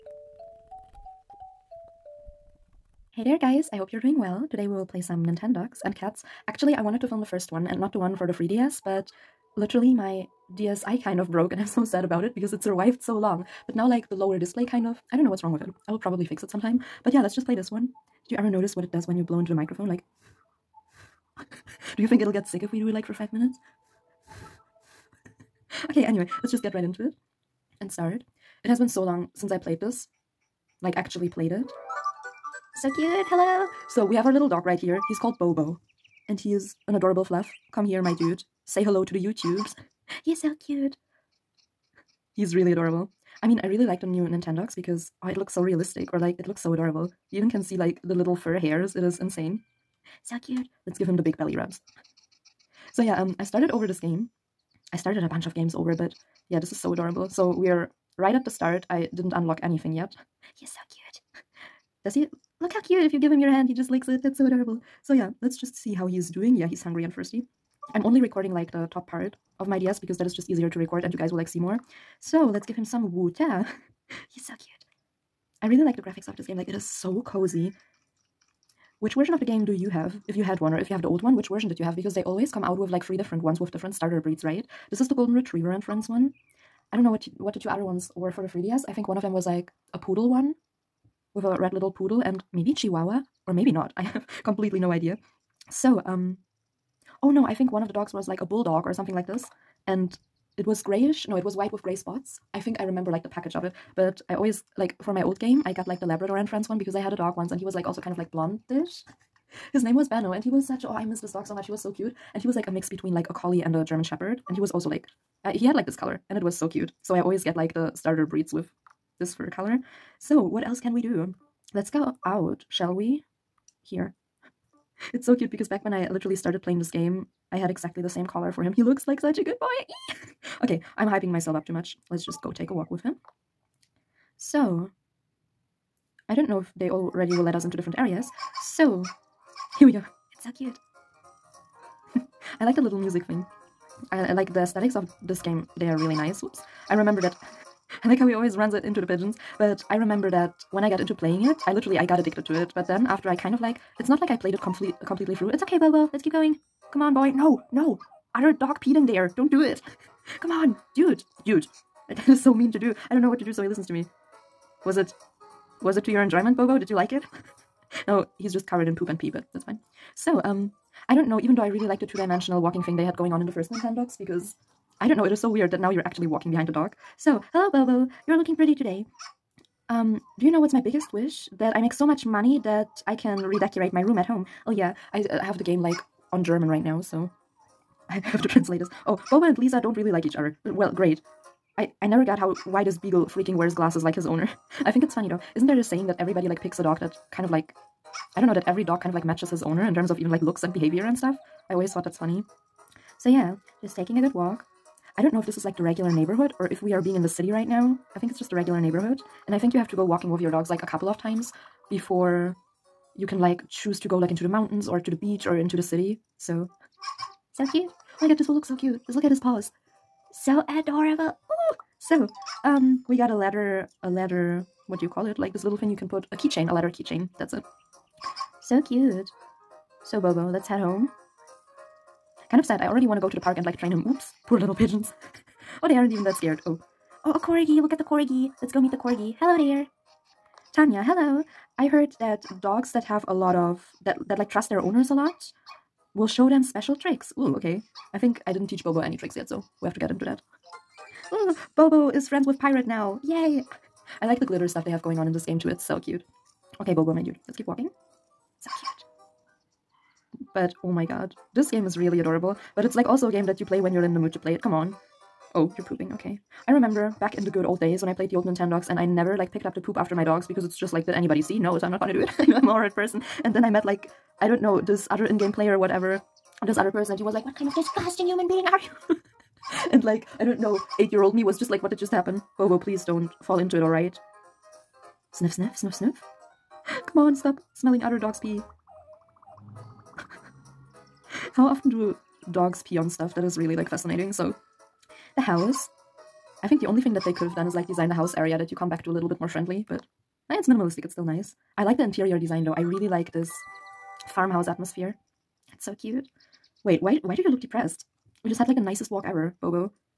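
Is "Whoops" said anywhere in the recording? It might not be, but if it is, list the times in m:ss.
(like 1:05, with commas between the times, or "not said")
2:26.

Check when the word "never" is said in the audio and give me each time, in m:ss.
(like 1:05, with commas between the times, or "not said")
3:12, 4:29.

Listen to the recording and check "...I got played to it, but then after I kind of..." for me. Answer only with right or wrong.
wrong.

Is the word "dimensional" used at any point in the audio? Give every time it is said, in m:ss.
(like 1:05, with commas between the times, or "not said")
2:52.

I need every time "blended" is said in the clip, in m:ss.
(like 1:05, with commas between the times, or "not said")
not said.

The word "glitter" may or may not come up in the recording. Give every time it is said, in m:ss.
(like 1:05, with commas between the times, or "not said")
4:14.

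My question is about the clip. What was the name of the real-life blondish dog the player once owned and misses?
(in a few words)
Benno.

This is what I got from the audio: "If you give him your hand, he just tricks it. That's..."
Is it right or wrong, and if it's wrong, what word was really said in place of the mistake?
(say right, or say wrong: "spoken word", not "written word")
wrong: "licks", not "tricks".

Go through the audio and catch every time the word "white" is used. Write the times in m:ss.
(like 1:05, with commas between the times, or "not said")
1:41.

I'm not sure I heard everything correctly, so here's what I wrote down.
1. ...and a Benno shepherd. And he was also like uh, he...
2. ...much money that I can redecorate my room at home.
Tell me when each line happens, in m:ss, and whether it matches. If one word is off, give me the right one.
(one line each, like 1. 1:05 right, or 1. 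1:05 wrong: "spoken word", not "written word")
1. 1:53 wrong: "German", not "Benno"
2. 3:02 right.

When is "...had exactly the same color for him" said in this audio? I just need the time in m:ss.
2:07.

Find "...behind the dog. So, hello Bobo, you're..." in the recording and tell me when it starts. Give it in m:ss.
2:56.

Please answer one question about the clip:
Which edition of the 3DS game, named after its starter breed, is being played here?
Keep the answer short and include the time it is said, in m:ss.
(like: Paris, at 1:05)
Golden Retriever and Friends, at 1:25.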